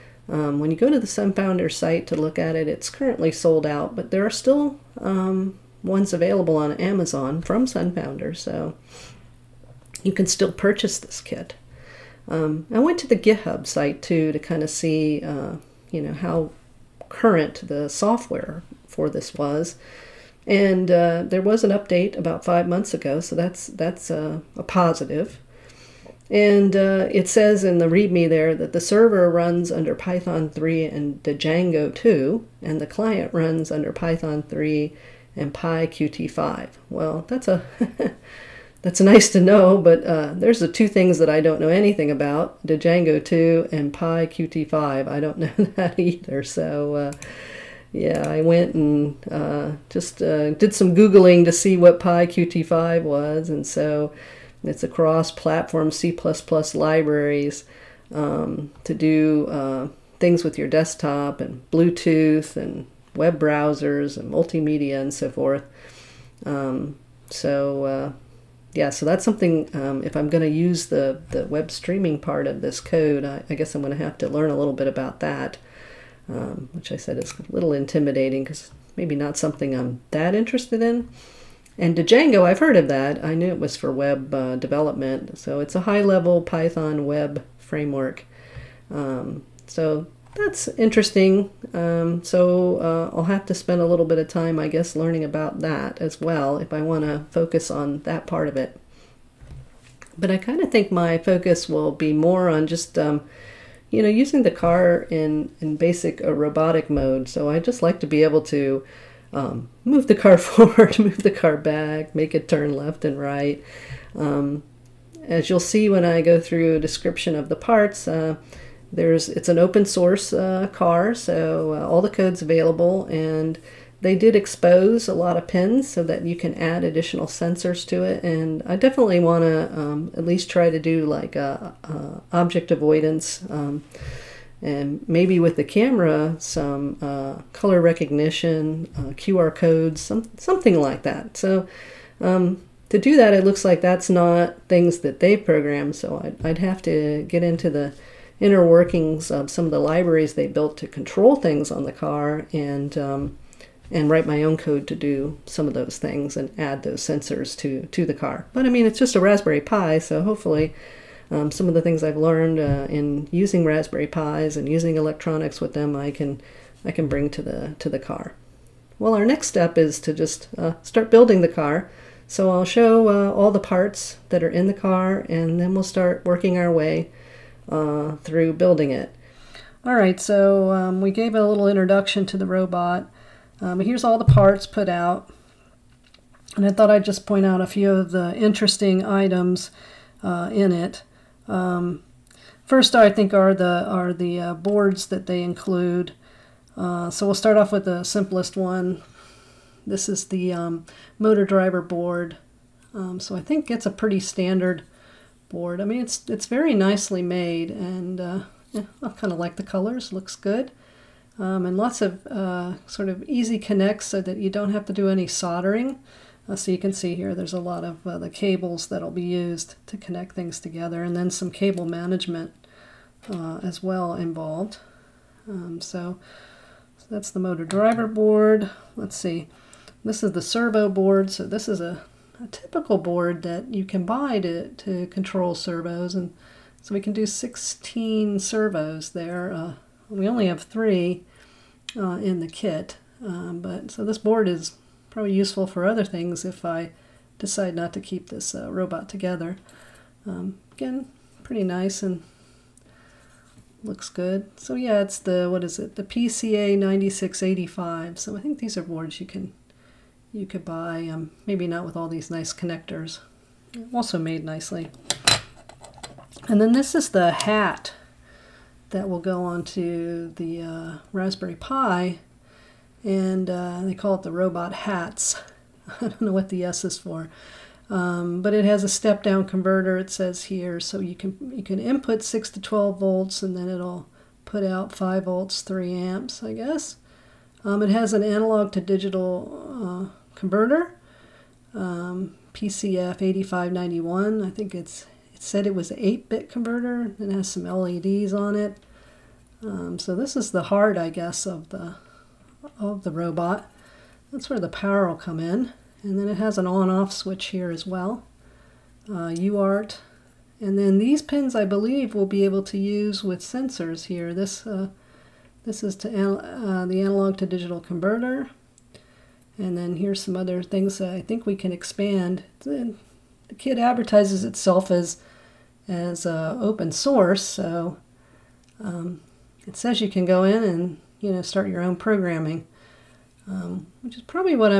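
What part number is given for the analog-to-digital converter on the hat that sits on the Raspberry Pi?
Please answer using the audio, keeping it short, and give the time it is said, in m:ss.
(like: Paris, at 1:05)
PCF 8591, at 4:52.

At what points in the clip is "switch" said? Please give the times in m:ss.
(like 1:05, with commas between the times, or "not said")
5:07.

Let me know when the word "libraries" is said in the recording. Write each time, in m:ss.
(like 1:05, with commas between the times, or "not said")
0:56, 2:29.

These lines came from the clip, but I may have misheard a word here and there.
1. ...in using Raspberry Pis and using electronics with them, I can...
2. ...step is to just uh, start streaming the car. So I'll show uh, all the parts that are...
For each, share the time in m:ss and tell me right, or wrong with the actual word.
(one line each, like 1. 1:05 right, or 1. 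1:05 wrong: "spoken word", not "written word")
1. 2:42 right
2. 2:49 wrong: "building", not "streaming".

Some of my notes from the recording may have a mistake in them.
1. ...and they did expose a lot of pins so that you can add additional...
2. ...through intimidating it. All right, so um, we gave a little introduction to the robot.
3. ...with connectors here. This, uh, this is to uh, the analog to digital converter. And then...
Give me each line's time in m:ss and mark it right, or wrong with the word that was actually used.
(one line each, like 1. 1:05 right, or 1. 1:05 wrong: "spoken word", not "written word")
1. 2:03 right
2. 2:58 wrong: "building", not "intimidating"
3. 5:13 wrong: "sensors", not "connectors".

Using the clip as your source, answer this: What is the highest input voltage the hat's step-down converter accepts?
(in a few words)
12 volts.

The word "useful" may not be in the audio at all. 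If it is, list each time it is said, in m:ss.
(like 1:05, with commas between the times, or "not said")
4:05.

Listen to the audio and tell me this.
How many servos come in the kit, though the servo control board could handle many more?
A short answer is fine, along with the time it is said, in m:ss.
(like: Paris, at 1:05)
3, at 4:00.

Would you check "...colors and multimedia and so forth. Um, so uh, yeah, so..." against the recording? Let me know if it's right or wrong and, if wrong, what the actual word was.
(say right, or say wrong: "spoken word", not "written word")
wrong: "browsers", not "colors".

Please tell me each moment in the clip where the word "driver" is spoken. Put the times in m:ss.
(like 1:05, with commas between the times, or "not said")
3:21, 3:47.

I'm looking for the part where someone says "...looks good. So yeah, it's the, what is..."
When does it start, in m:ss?
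4:13.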